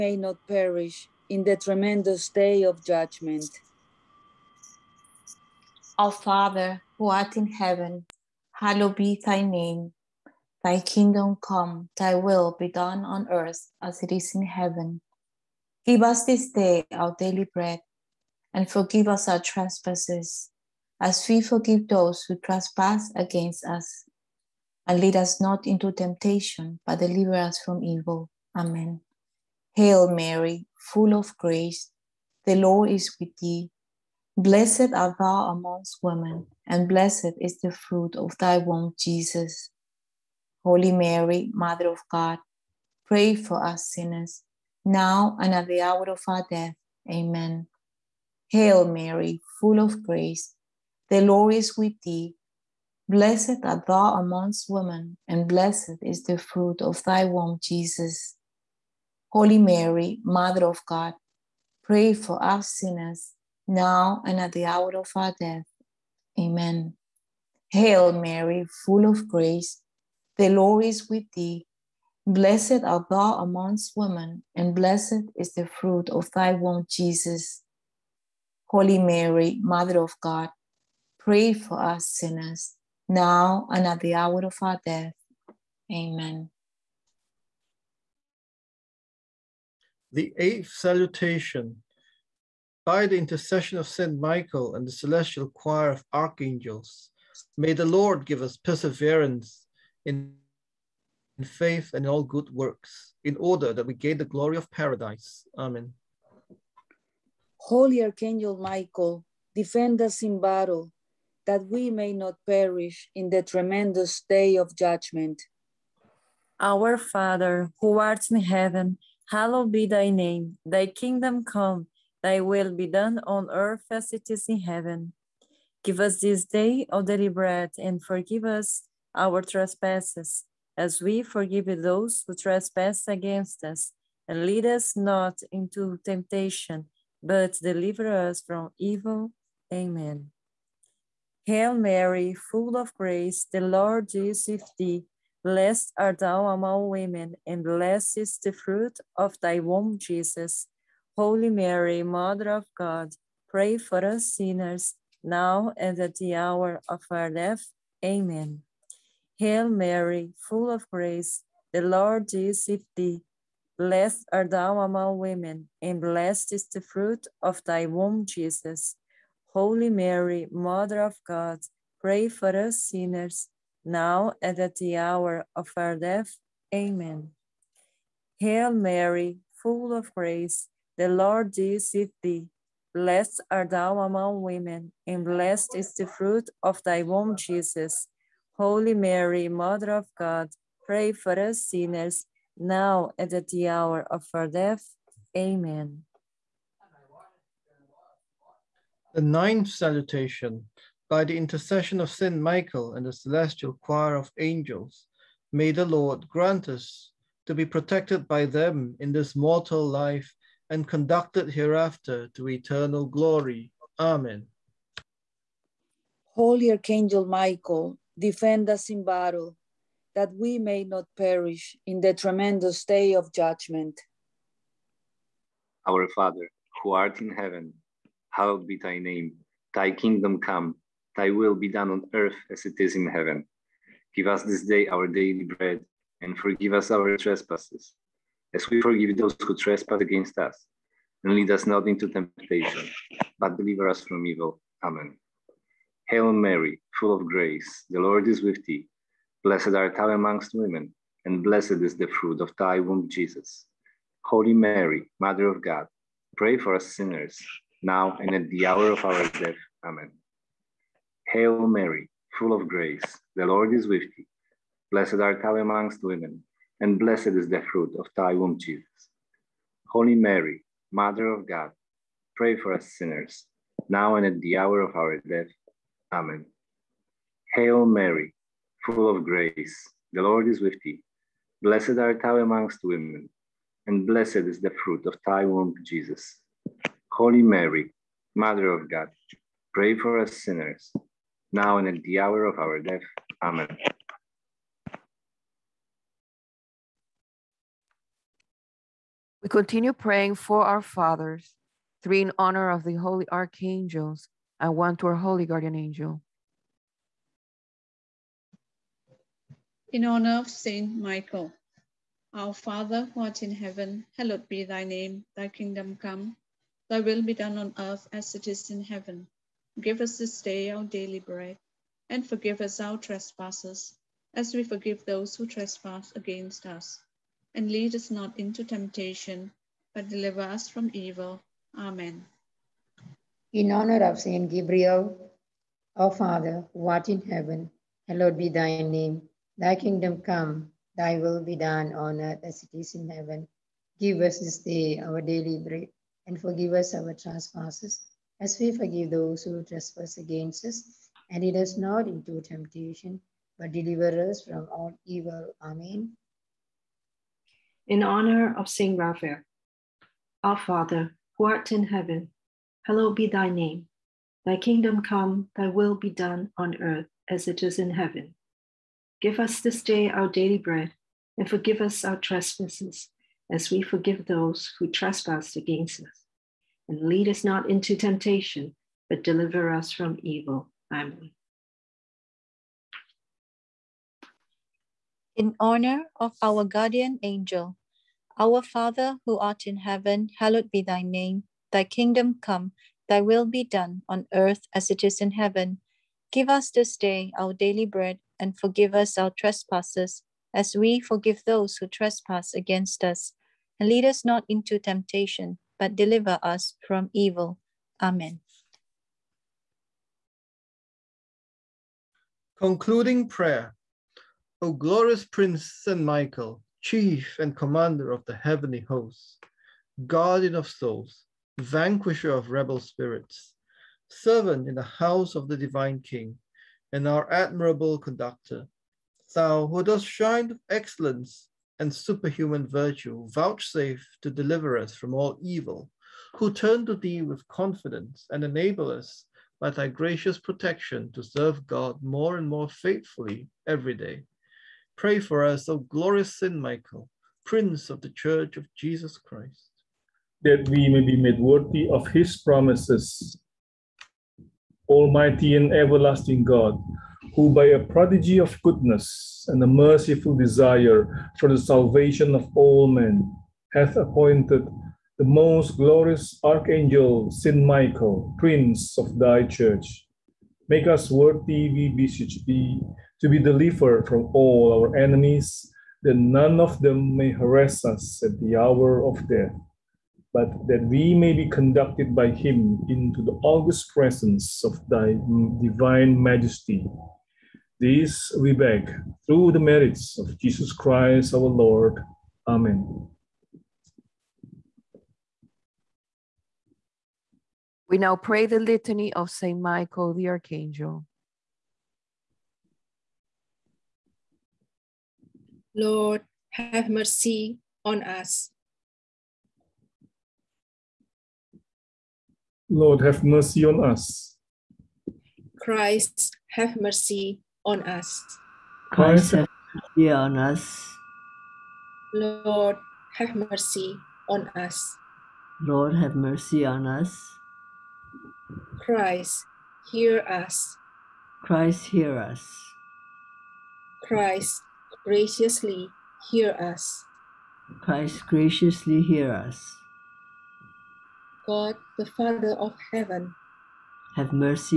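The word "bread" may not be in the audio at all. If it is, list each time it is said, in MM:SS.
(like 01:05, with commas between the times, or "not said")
00:17, 02:07, 03:55, 05:21, 05:45, 06:10, 06:37.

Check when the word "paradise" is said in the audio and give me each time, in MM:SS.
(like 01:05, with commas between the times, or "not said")
01:44.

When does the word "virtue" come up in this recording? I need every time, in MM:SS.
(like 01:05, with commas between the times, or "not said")
07:12.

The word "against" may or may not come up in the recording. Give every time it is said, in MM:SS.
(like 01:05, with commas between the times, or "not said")
00:23, 02:13, 04:00, 05:26, 05:50, 06:15, 06:42.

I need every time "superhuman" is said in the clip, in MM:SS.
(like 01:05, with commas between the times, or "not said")
07:11.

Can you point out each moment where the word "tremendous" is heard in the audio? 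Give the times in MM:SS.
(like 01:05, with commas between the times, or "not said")
00:01, 01:53, 03:42.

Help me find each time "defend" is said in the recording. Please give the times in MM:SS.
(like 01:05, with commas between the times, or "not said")
01:49, 03:38.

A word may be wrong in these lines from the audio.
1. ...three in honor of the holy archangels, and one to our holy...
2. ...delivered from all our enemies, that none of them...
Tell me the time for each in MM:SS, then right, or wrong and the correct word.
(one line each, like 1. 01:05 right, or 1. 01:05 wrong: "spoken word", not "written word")
1. 05:02 right
2. 07:53 right.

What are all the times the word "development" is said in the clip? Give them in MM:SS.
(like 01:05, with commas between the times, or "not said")
not said.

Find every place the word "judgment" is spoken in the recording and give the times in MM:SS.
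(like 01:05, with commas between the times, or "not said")
00:02, 01:54, 03:43.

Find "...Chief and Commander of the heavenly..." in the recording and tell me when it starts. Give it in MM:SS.
06:56.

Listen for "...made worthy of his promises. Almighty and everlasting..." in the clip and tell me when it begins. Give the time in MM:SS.
07:31.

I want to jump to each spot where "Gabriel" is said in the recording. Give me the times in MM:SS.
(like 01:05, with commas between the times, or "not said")
05:34.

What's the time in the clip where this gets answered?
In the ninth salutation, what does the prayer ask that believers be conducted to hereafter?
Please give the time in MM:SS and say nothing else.
03:32.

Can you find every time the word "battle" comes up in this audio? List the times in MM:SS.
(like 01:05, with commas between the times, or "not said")
01:50, 03:39.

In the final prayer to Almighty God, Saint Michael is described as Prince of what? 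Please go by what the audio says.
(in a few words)
thy church.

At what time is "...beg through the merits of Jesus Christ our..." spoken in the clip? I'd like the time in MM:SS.
08:08.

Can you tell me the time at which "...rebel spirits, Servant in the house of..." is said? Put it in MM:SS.
07:02.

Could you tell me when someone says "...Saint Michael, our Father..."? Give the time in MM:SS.
05:10.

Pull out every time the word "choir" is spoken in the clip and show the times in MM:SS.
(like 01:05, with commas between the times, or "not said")
01:35, 03:23.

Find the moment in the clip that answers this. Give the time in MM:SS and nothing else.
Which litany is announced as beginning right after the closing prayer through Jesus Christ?
08:18.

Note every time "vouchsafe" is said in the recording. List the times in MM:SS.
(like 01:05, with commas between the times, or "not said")
07:13.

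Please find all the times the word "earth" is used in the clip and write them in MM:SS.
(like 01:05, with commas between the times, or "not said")
00:13, 02:03, 03:52, 05:17, 05:42, 06:06, 06:34.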